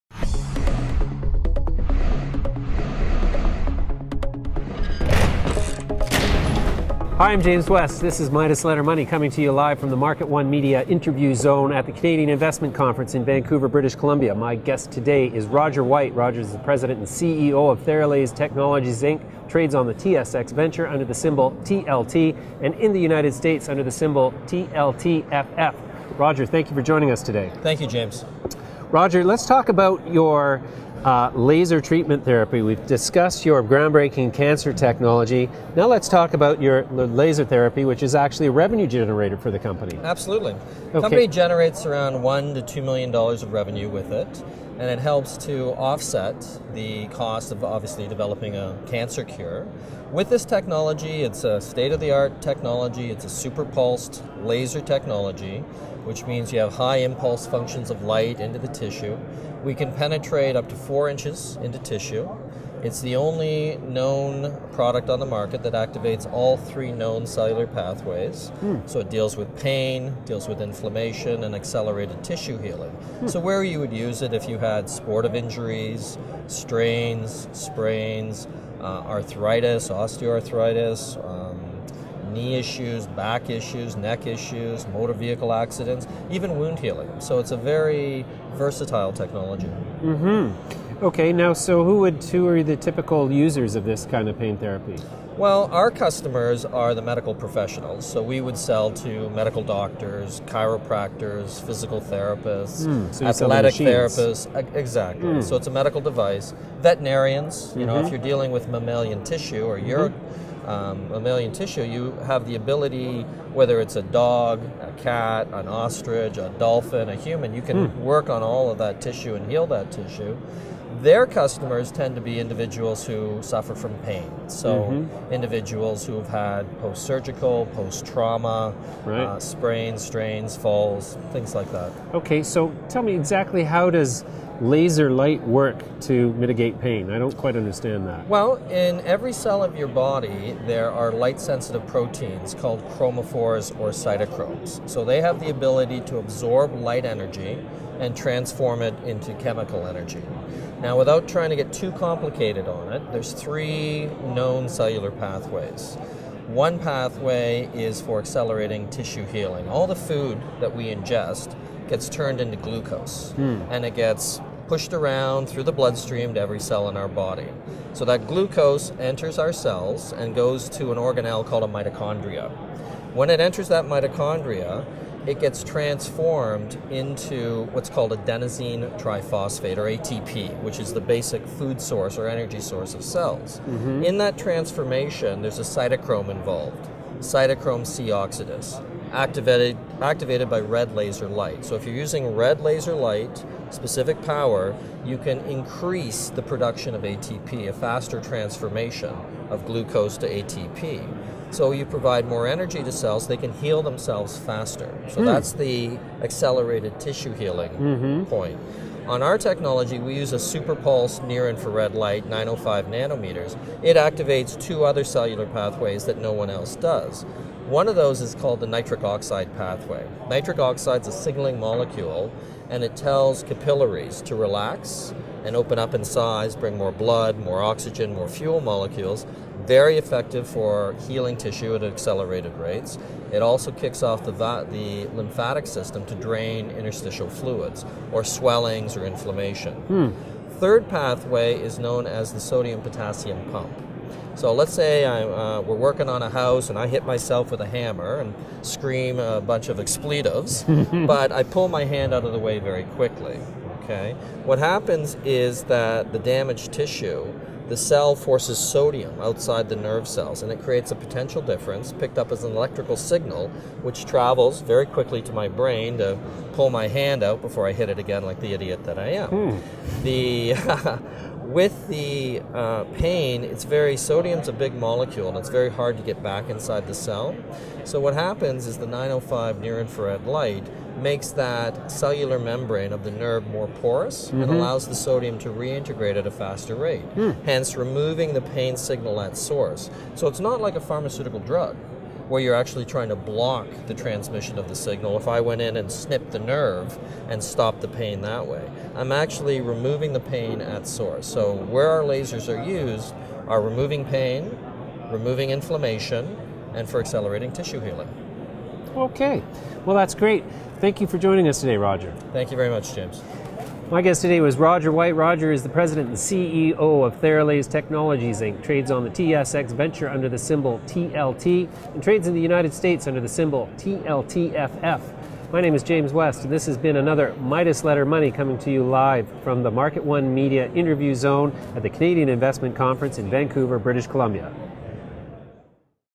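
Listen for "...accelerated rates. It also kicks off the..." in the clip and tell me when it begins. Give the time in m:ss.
3:51.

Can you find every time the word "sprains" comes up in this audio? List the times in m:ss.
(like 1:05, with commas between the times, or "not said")
1:17, 2:09.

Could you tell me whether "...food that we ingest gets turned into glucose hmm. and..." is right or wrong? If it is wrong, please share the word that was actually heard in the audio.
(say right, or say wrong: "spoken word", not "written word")
right.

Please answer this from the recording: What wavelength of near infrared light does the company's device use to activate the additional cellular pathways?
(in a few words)
905 nanometers.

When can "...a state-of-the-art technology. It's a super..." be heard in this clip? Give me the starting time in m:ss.
0:51.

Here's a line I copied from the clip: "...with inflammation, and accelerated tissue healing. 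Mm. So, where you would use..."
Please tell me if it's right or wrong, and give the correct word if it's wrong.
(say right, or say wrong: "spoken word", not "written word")
right.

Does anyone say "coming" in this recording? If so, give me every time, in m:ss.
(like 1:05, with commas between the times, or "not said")
0:09, 5:28.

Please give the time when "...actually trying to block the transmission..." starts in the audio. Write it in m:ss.
4:52.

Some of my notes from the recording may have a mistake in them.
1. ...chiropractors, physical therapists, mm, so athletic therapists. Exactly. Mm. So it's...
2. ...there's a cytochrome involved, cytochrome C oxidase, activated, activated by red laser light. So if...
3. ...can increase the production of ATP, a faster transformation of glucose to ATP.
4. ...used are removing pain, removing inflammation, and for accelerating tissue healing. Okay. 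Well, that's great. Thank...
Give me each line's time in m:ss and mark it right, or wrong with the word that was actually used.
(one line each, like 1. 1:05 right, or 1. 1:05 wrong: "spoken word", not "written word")
1. 1:40 right
2. 3:05 right
3. 3:15 right
4. 5:02 right.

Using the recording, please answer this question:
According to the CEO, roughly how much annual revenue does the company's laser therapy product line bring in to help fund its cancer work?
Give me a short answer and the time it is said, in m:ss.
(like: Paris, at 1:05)
1 to 2 million dollars, at 0:42.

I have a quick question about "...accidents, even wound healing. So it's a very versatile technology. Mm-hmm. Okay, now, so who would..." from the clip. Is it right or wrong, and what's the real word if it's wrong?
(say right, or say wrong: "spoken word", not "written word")
right.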